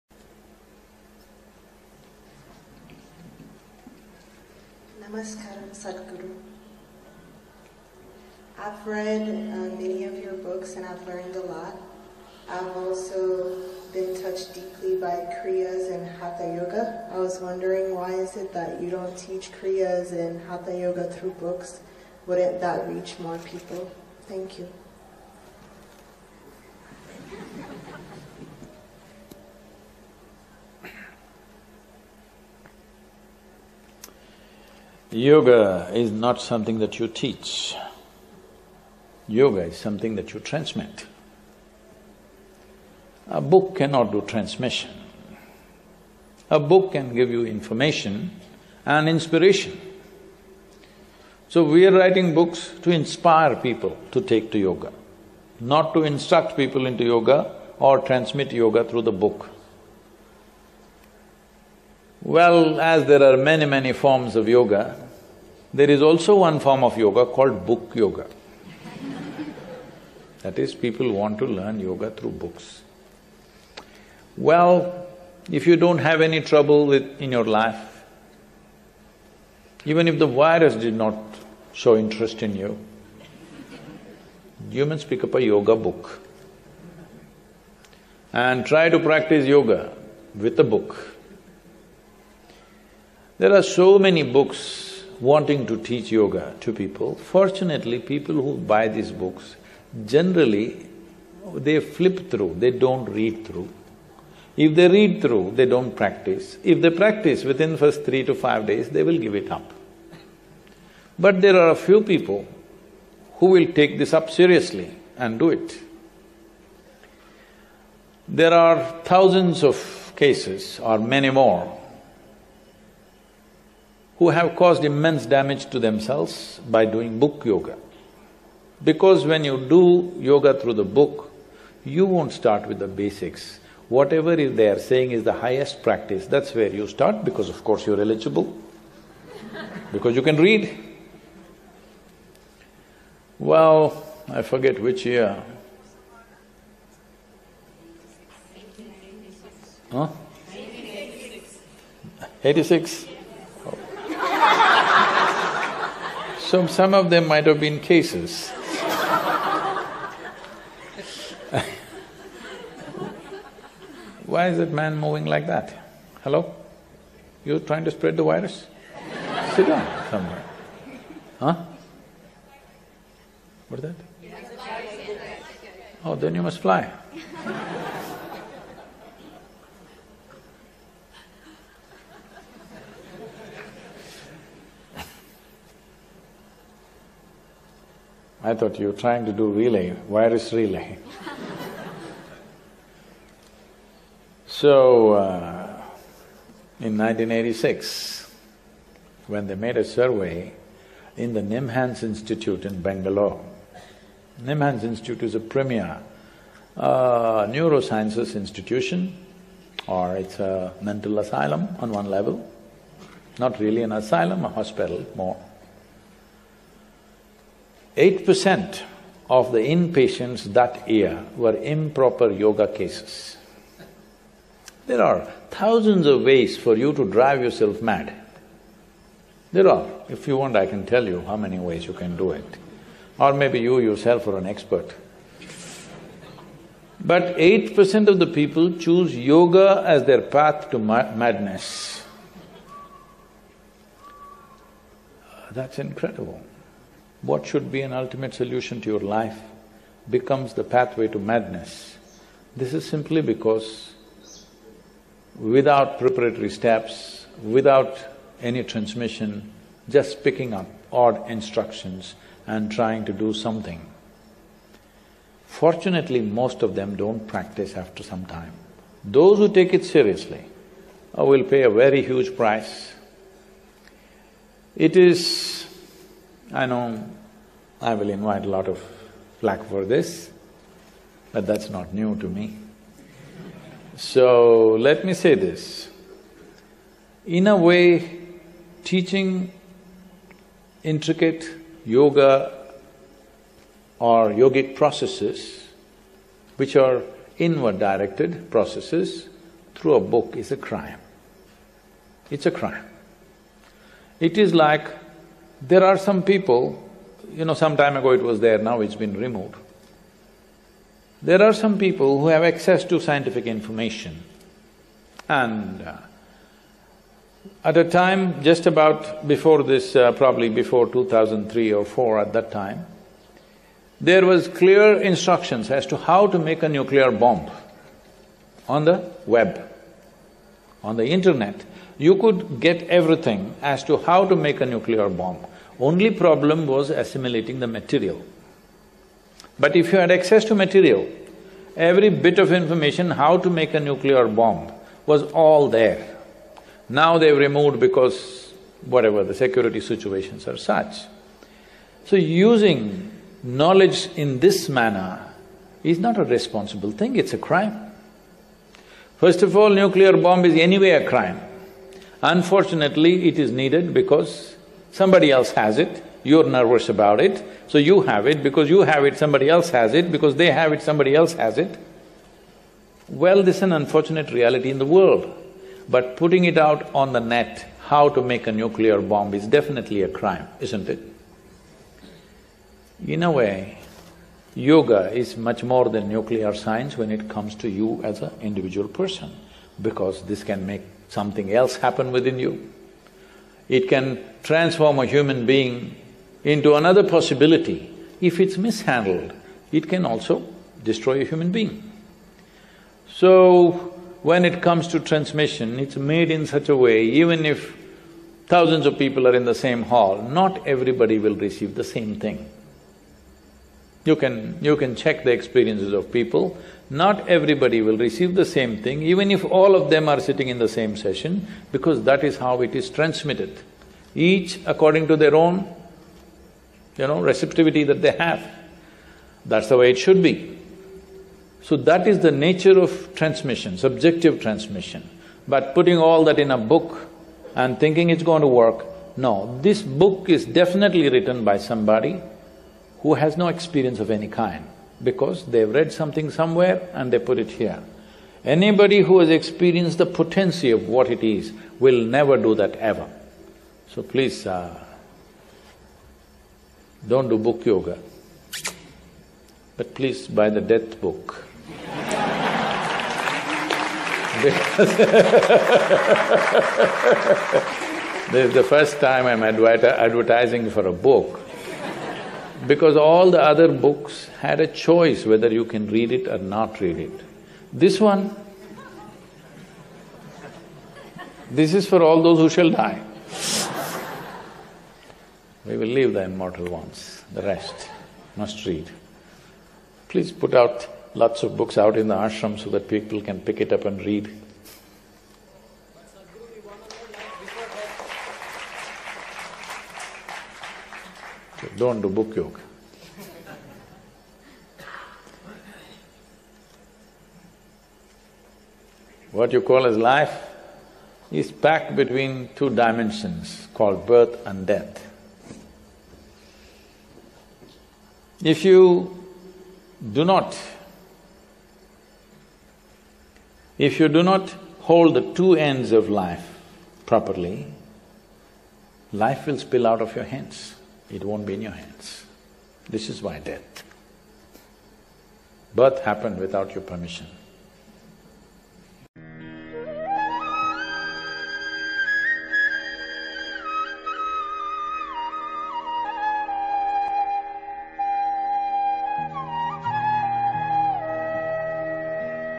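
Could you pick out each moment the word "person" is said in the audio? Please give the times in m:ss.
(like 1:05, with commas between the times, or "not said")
6:28.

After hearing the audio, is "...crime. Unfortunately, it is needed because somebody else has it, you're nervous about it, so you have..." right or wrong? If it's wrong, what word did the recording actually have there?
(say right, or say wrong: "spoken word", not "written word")
right.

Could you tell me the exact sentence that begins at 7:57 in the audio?
This one, this is for all those who shall die.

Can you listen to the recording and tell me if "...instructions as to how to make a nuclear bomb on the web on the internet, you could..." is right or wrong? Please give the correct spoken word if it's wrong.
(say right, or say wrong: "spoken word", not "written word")
right.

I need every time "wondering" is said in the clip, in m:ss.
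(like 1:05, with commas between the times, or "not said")
0:17.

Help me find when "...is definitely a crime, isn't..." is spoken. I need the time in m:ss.
6:19.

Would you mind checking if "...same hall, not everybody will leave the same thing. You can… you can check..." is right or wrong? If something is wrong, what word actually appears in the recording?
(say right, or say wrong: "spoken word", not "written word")
wrong: "receive", not "leave".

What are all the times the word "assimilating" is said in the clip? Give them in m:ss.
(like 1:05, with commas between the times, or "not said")
5:36.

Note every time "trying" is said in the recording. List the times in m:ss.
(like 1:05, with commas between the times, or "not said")
2:47, 3:08, 4:22.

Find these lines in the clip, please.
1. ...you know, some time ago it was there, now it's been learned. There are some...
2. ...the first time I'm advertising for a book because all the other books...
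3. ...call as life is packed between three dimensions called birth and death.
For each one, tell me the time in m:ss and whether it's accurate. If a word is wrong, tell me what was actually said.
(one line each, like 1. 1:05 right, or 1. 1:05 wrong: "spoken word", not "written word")
1. 5:07 wrong: "removed", not "learned"
2. 7:48 right
3. 8:29 wrong: "two", not "three".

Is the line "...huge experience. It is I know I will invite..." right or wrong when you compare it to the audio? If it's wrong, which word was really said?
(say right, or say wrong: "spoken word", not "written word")
wrong: "price", not "experience".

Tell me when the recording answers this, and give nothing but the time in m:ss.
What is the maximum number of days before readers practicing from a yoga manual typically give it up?
1:48.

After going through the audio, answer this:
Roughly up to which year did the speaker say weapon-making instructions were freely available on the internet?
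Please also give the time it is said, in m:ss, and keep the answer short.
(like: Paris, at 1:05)
2003, at 5:20.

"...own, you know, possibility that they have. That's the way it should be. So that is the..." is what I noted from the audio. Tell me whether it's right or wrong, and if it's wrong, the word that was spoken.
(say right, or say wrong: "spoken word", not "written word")
wrong: "receptivity", not "possibility".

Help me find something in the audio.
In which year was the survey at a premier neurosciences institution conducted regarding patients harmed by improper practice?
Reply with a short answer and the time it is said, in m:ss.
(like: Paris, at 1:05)
1986, at 3:16.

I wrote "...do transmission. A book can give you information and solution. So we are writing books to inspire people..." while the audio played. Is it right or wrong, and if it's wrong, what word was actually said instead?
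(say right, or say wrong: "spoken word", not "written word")
wrong: "inspiration", not "solution".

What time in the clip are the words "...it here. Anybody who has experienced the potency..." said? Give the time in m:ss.
7:27.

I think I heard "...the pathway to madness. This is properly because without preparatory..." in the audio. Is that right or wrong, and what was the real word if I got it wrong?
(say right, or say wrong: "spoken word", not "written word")
wrong: "simply", not "properly".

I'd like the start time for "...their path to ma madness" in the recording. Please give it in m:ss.
4:00.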